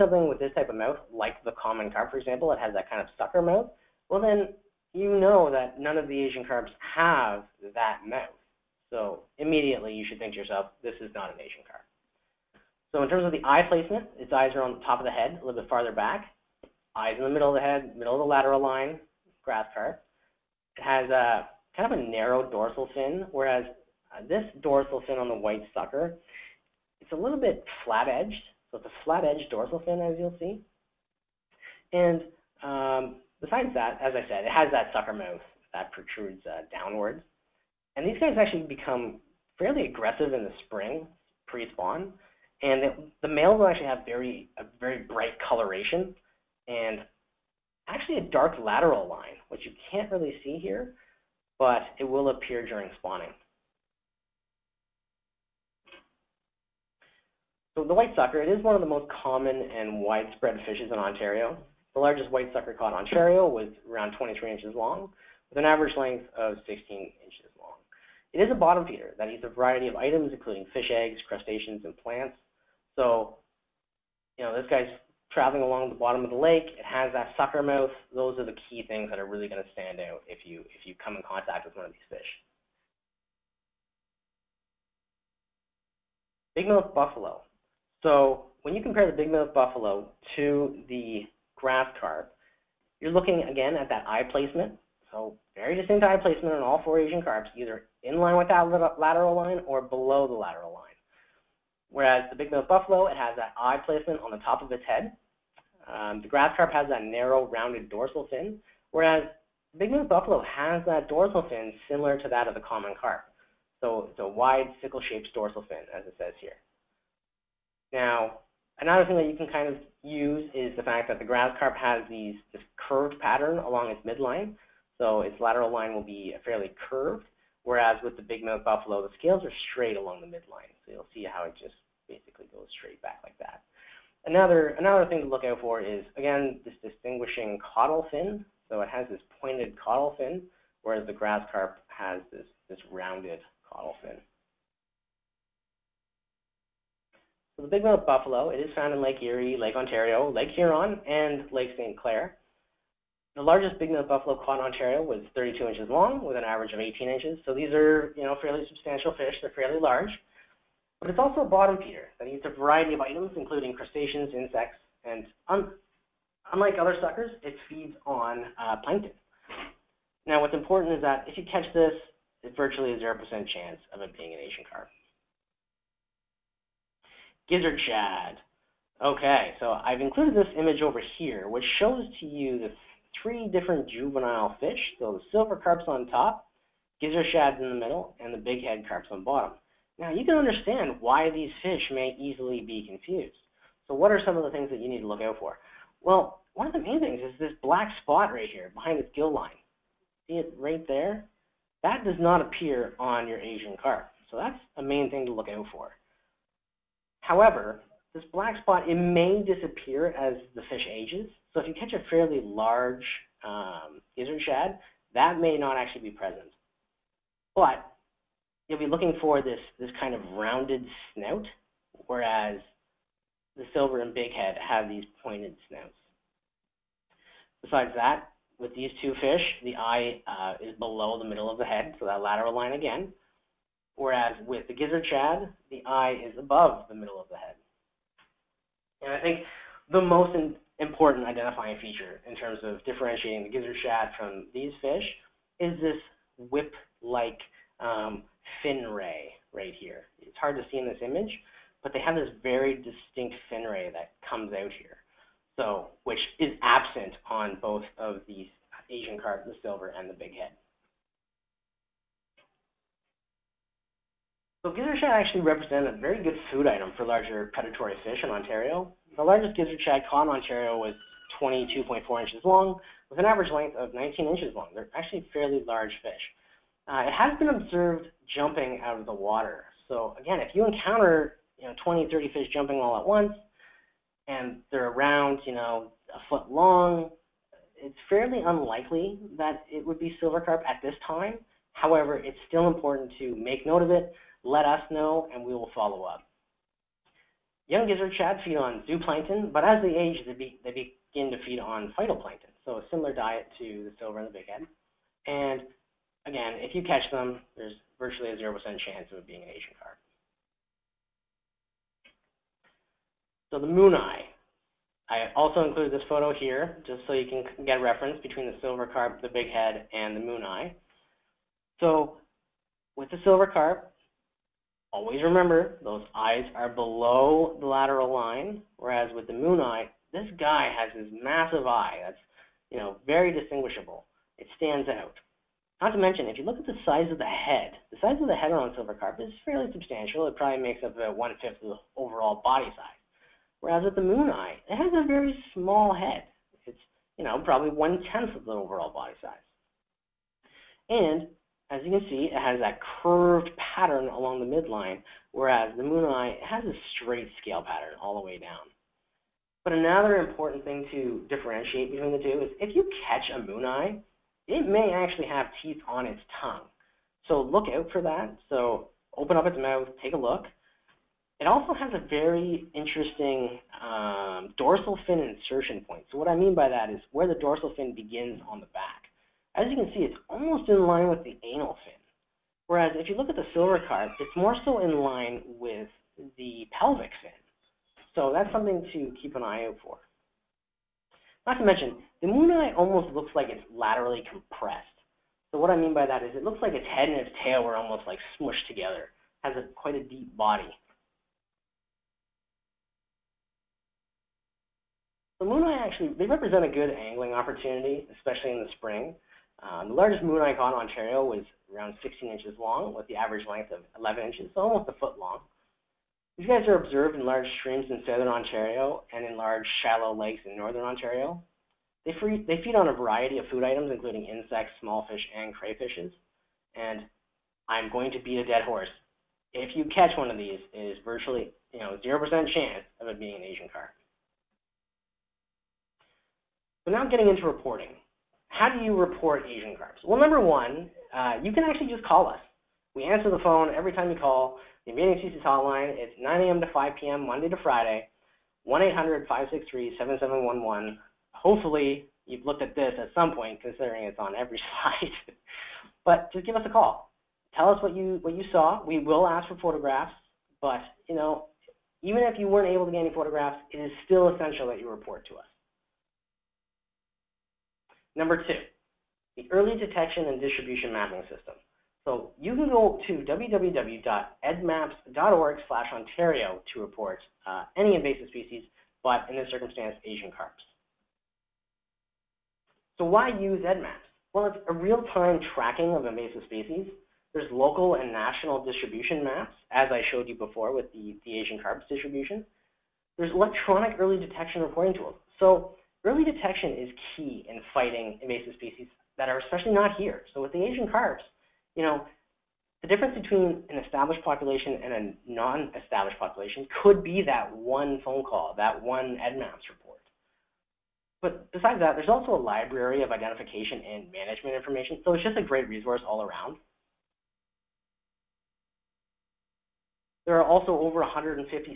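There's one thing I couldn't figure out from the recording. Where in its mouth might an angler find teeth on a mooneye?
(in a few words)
on its tongue.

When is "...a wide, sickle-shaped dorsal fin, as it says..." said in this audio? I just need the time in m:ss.
1:54.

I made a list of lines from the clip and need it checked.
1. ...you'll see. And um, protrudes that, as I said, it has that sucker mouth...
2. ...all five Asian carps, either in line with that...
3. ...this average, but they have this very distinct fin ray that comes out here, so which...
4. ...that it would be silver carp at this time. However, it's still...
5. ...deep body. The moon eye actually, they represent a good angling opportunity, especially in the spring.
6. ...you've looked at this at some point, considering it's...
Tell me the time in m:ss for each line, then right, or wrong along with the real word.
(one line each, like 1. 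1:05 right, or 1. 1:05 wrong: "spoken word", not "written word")
1. 0:30 wrong: "besides", not "protrudes"
2. 1:36 wrong: "four", not "five"
3. 4:10 wrong: "image", not "average"
4. 4:49 right
5. 6:40 right
6. 7:32 right.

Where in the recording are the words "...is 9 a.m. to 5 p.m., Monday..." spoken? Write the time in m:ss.
7:25.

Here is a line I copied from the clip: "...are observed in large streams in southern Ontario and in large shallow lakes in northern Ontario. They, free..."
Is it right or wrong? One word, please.
right.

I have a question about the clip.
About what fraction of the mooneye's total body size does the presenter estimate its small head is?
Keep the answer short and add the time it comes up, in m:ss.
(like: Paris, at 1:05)
one tenth, at 5:47.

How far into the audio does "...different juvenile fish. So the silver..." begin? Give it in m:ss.
3:03.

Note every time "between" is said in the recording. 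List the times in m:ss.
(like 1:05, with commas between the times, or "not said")
5:18, 6:01, 8:23.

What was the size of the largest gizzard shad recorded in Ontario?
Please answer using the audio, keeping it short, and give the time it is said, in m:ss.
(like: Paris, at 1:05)
22.4 inches, at 4:31.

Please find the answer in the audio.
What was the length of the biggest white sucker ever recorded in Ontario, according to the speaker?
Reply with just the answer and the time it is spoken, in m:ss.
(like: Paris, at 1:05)
23 inches, at 1:04.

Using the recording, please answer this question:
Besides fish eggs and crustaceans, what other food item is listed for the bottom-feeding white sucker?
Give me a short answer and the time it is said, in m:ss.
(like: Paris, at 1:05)
plants, at 1:11.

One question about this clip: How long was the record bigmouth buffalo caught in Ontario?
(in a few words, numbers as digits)
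32 inches.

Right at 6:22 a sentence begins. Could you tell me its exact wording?
Whereas if you look at the silver carp, it's more so in line with the pelvic fin.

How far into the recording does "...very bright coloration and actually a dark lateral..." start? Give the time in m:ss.
0:44.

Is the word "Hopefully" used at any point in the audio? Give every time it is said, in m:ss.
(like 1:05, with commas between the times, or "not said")
7:31.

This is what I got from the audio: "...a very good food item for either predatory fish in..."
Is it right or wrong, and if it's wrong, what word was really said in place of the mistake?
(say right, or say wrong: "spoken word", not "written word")
wrong: "larger", not "either".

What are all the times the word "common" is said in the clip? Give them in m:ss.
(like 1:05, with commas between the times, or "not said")
0:01, 0:59, 1:52.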